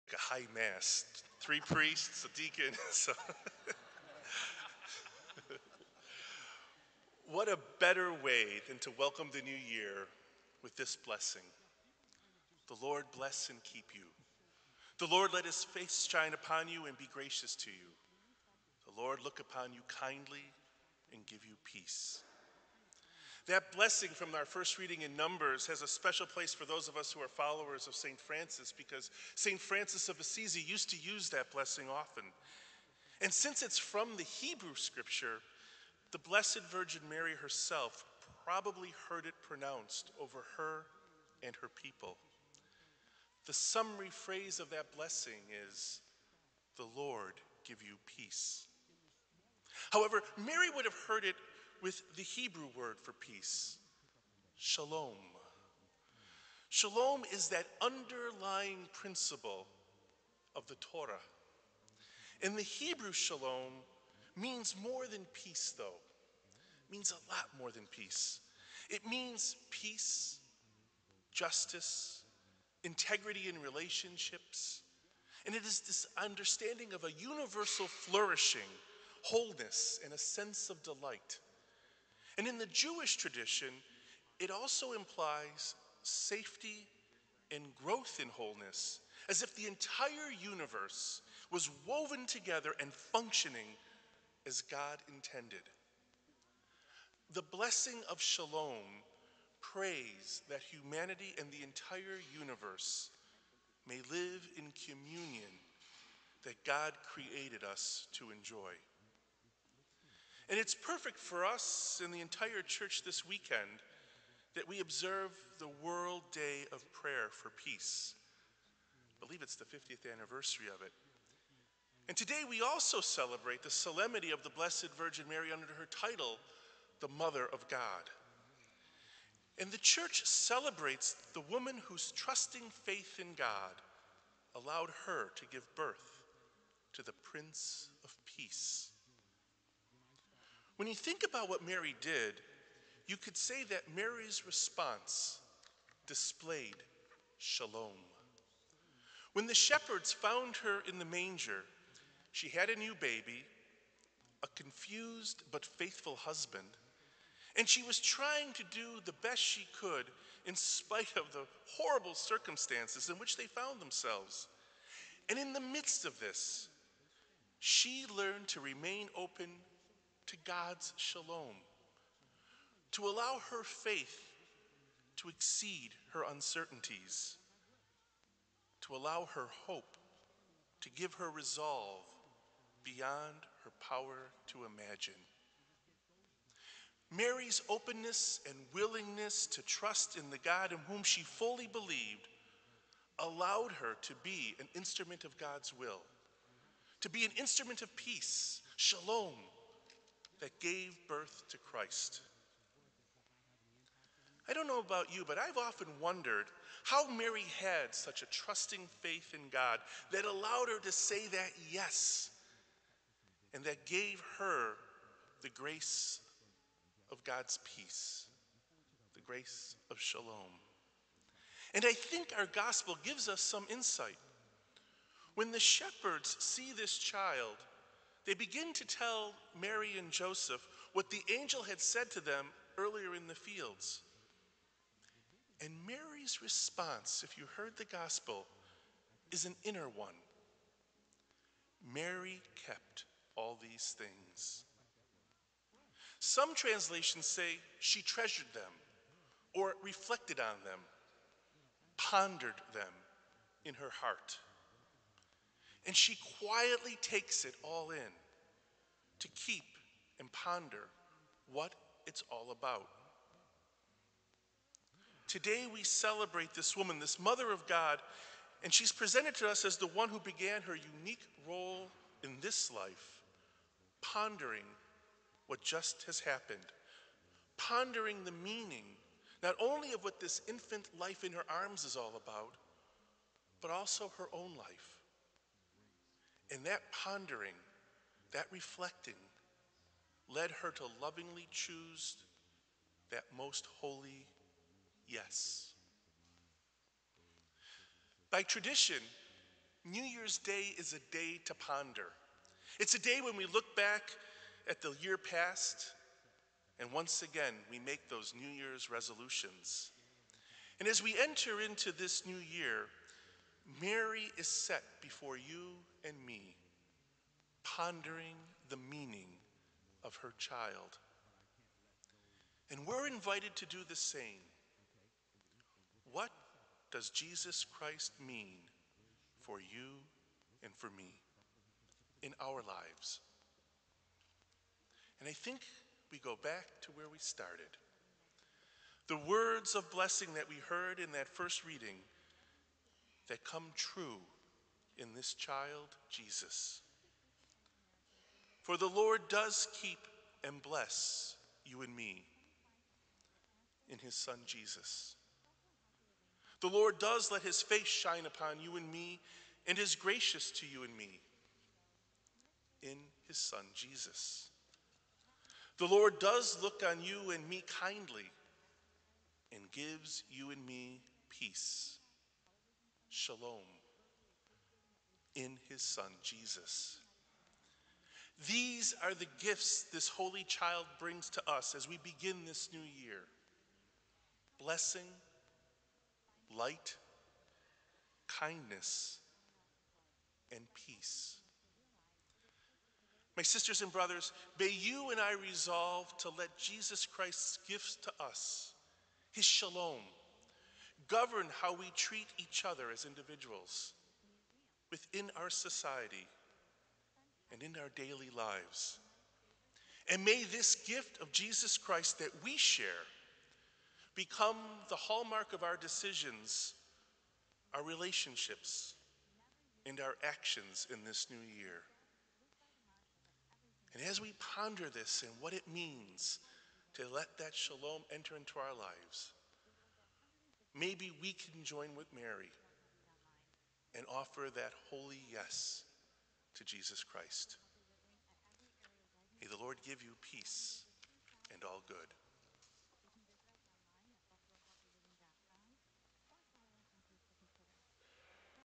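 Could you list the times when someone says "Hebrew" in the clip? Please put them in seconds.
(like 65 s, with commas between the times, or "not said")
34 s, 52 s, 62 s.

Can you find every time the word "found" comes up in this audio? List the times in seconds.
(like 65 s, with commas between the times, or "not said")
150 s, 163 s.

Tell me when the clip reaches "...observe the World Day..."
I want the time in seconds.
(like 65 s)
114 s.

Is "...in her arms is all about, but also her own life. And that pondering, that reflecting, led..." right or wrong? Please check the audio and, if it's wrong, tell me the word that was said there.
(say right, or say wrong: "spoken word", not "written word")
right.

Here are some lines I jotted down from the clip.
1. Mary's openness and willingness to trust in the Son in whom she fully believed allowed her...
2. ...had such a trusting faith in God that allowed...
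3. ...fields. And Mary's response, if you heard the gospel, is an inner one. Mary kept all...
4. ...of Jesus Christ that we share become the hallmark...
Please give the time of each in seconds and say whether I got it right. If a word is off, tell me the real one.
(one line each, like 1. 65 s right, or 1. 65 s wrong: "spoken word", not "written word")
1. 187 s wrong: "God", not "Son"
2. 207 s right
3. 233 s right
4. 411 s right.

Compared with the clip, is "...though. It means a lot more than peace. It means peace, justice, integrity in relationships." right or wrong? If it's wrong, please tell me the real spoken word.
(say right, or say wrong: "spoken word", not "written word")
right.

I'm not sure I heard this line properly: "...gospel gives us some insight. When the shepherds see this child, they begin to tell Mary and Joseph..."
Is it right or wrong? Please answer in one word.
right.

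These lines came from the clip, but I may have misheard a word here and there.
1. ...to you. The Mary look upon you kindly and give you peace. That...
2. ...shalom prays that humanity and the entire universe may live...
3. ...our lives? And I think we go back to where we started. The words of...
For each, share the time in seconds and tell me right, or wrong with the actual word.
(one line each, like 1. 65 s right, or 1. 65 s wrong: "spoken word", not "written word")
1. 17 s wrong: "Lord", not "Mary"
2. 98 s right
3. 332 s right.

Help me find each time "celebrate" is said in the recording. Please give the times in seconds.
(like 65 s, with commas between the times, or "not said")
122 s, 130 s, 265 s.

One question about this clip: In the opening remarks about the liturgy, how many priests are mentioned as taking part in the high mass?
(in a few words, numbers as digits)
3.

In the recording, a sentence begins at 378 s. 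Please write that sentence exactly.
These are the gifts this holy child brings to us as we begin this new year blessing, light, kindness, and peace.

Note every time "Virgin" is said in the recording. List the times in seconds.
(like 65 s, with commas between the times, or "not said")
36 s, 124 s.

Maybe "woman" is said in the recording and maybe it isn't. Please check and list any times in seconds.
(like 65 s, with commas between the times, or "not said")
131 s, 266 s.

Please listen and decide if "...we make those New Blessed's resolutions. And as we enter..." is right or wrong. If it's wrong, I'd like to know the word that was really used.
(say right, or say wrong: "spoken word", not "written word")
wrong: "Year", not "Blessed".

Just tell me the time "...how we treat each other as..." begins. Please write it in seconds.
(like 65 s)
401 s.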